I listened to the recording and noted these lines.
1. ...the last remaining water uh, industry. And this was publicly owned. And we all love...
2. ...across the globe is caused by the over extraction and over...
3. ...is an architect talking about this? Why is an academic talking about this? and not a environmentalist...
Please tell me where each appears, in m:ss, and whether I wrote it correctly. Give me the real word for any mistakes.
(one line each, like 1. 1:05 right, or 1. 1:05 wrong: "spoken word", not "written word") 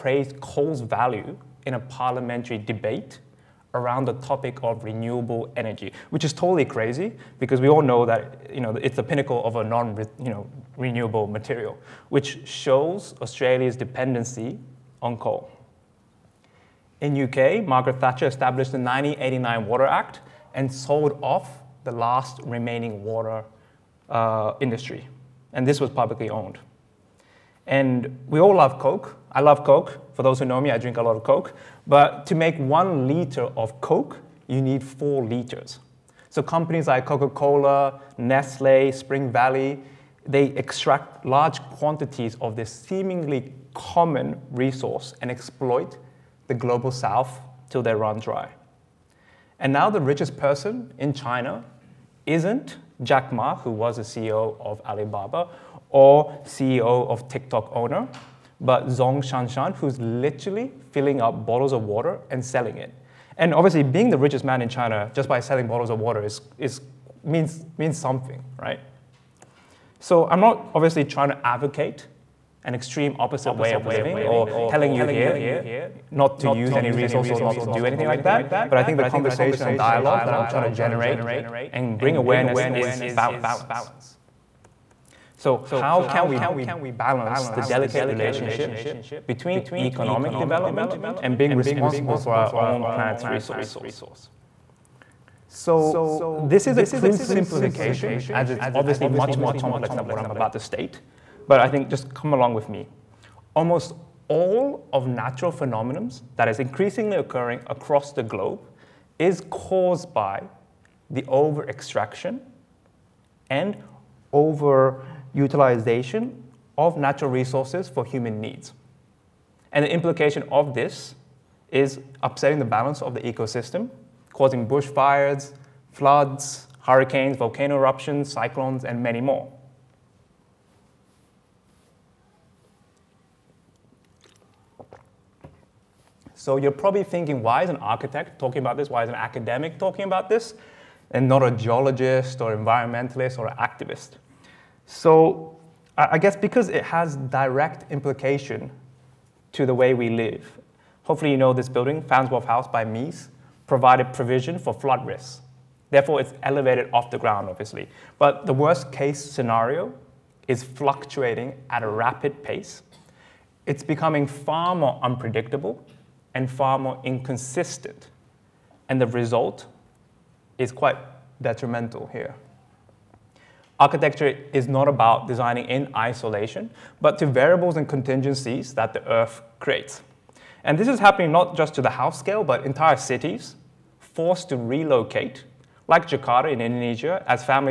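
1. 0:21 right
2. 1:47 right
3. 2:17 wrong: "geologist", not "environmentalist".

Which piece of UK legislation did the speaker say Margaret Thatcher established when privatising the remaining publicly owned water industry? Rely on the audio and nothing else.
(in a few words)
1989 Water Act.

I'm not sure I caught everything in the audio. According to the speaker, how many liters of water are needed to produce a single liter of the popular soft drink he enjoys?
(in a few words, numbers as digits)
4 liters.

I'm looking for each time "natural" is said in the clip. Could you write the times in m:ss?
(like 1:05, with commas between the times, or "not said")
1:45, 1:56.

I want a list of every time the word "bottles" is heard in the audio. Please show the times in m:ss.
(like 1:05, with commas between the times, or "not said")
1:01, 1:05.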